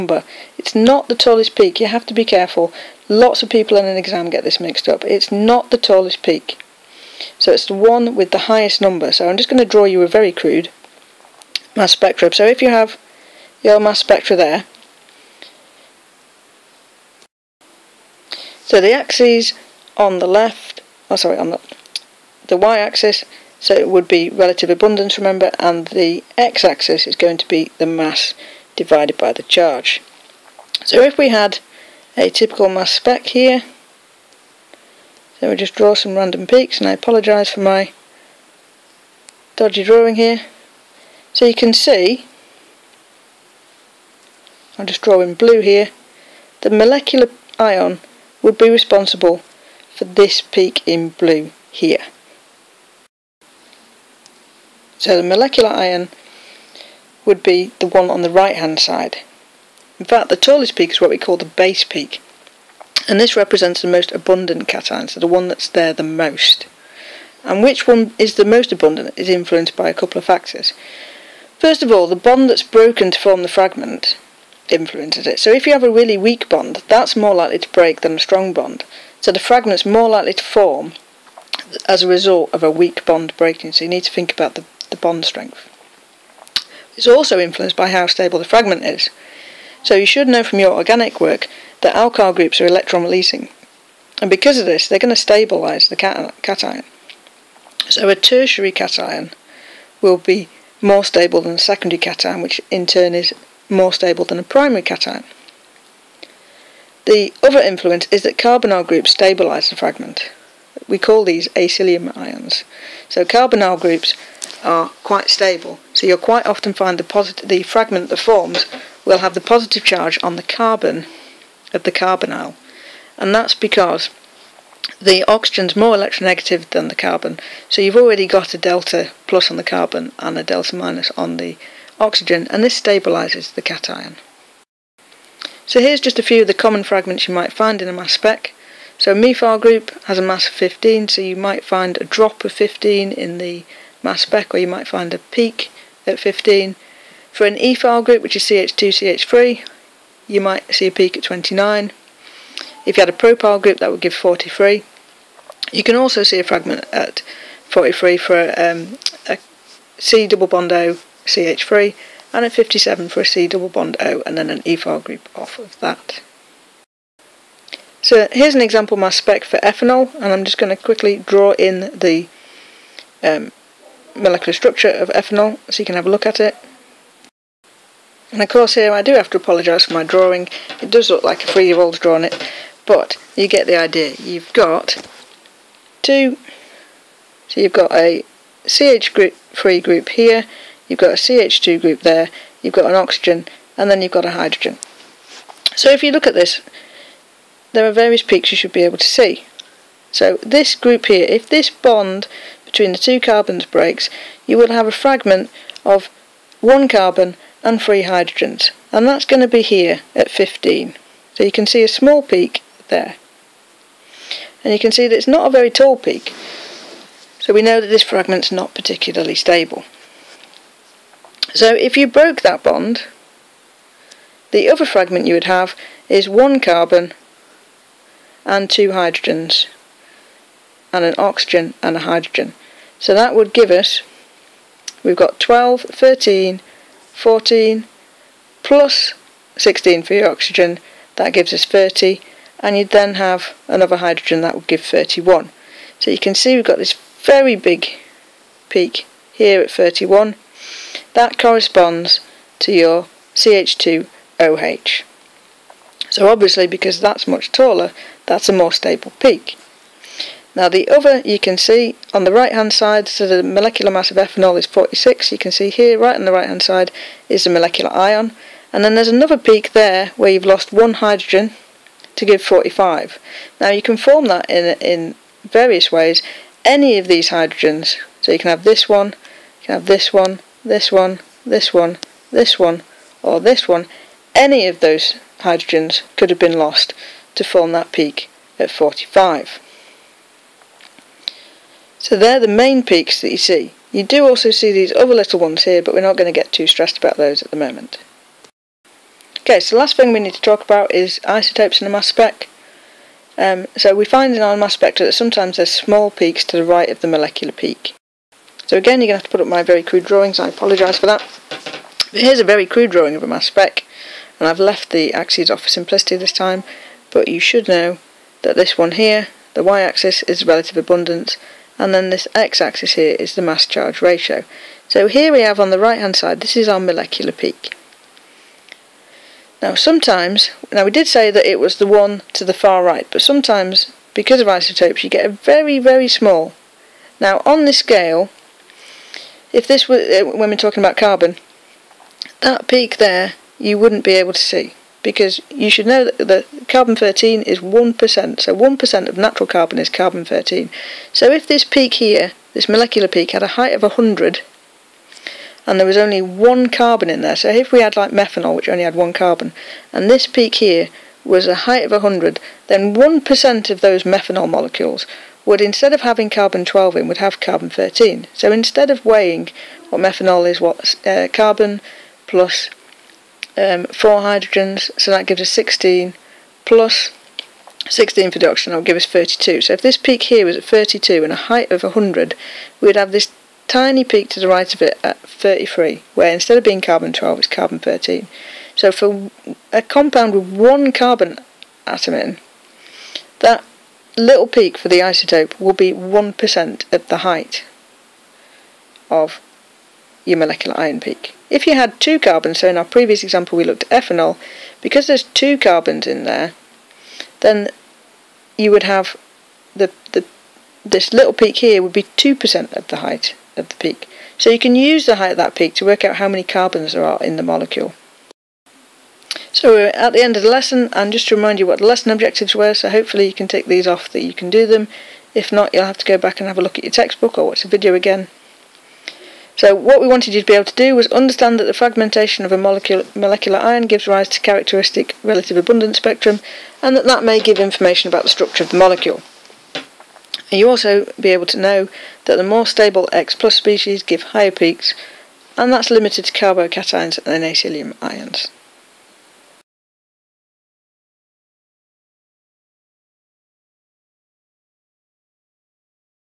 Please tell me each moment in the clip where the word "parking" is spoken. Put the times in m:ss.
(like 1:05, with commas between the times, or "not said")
not said.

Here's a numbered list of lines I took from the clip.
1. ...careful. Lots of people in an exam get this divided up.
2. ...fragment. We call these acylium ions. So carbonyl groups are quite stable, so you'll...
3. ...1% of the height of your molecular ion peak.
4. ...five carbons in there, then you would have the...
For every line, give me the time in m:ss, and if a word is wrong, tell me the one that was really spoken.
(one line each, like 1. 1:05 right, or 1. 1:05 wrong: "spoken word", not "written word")
1. 0:02 wrong: "mixed", not "divided"
2. 1:49 right
3. 6:35 right
4. 6:45 wrong: "two", not "five".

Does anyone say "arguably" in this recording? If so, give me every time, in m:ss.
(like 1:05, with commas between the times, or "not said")
not said.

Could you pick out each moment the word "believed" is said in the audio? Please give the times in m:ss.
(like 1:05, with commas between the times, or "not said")
not said.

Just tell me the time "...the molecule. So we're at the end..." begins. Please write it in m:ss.
6:57.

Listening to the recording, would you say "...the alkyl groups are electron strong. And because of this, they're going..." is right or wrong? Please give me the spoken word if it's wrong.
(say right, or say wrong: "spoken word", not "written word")
wrong: "releasing", not "strong".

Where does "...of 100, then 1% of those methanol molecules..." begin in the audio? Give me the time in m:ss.
6:01.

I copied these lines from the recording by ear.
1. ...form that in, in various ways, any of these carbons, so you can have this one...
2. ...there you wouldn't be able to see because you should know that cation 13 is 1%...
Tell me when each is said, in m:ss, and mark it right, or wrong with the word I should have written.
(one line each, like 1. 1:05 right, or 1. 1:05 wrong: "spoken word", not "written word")
1. 4:33 wrong: "hydrogens", not "carbons"
2. 5:42 wrong: "carbon", not "cation".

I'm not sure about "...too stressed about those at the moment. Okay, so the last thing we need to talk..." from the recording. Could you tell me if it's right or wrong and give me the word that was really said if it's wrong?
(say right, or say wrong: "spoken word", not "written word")
right.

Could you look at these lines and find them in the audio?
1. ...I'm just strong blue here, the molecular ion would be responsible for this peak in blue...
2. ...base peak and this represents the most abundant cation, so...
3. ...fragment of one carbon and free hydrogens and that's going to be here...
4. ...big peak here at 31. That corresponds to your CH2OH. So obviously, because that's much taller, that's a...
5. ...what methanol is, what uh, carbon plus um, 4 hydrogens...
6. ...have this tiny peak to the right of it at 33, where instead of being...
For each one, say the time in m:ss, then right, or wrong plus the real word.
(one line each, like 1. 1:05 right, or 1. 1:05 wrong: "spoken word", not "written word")
1. 0:44 wrong: "drawing", not "strong"
2. 1:01 right
3. 3:24 right
4. 4:07 right
5. 6:09 right
6. 6:22 right.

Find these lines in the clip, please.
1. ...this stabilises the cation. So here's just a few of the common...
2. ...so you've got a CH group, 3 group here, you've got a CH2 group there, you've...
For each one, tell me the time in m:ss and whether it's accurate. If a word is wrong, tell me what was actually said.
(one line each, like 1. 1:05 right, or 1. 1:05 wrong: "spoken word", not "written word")
1. 2:12 right
2. 3:07 right.